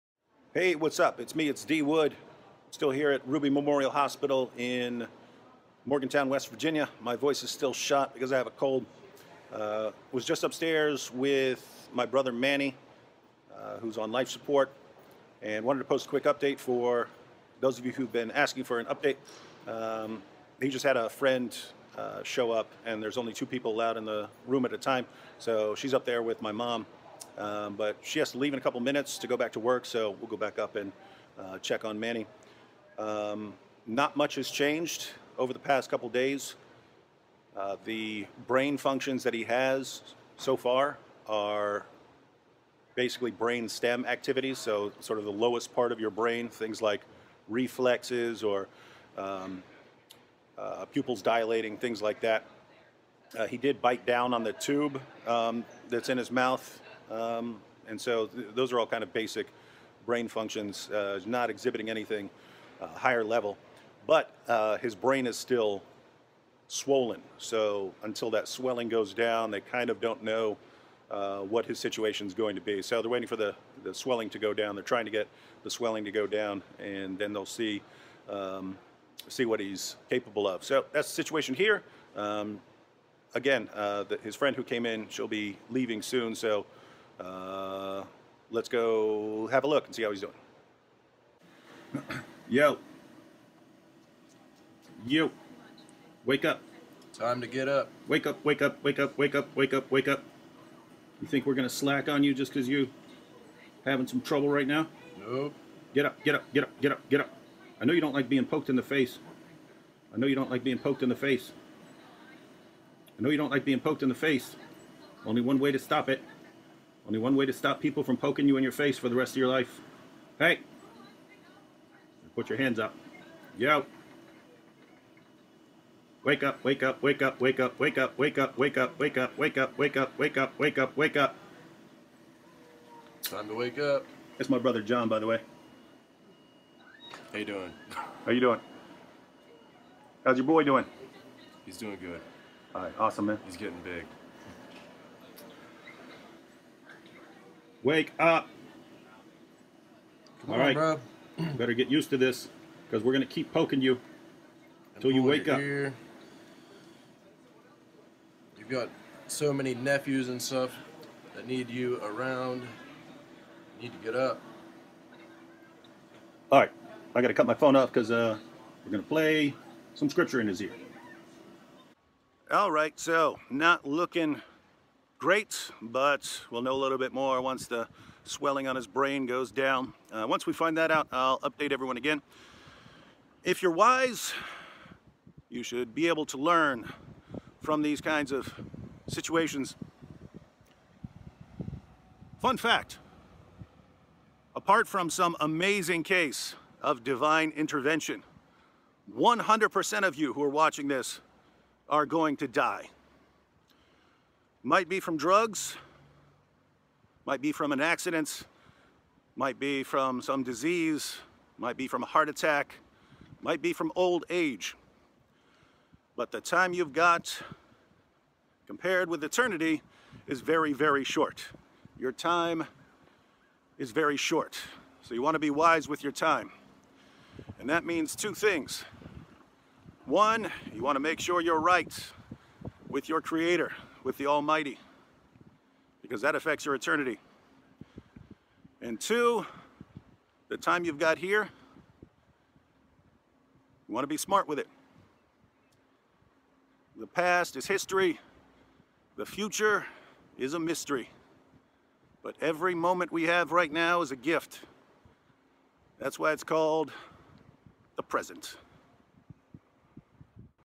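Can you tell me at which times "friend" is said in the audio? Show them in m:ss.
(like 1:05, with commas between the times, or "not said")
0:21, 1:24.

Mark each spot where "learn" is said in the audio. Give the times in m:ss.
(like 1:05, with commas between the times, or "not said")
3:06.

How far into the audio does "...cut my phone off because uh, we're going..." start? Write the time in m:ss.
2:47.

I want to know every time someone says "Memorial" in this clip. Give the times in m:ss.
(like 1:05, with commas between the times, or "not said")
0:03.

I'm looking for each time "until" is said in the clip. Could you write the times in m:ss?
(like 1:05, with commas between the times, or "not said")
1:08, 2:34.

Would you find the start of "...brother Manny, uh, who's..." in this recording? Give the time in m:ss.
0:12.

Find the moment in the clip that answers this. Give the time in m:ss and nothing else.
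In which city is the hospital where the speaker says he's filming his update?
0:05.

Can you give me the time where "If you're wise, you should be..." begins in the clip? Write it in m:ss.
3:03.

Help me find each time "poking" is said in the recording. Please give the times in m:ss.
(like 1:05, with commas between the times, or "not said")
1:58, 2:33.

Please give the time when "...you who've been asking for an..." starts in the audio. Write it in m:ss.
0:17.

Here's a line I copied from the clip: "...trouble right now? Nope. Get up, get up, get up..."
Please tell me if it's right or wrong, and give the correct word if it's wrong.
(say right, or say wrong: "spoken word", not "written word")
right.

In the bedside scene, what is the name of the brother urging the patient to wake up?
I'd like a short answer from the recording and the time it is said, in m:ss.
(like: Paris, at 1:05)
John, at 2:14.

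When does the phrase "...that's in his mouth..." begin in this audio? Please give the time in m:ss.
0:55.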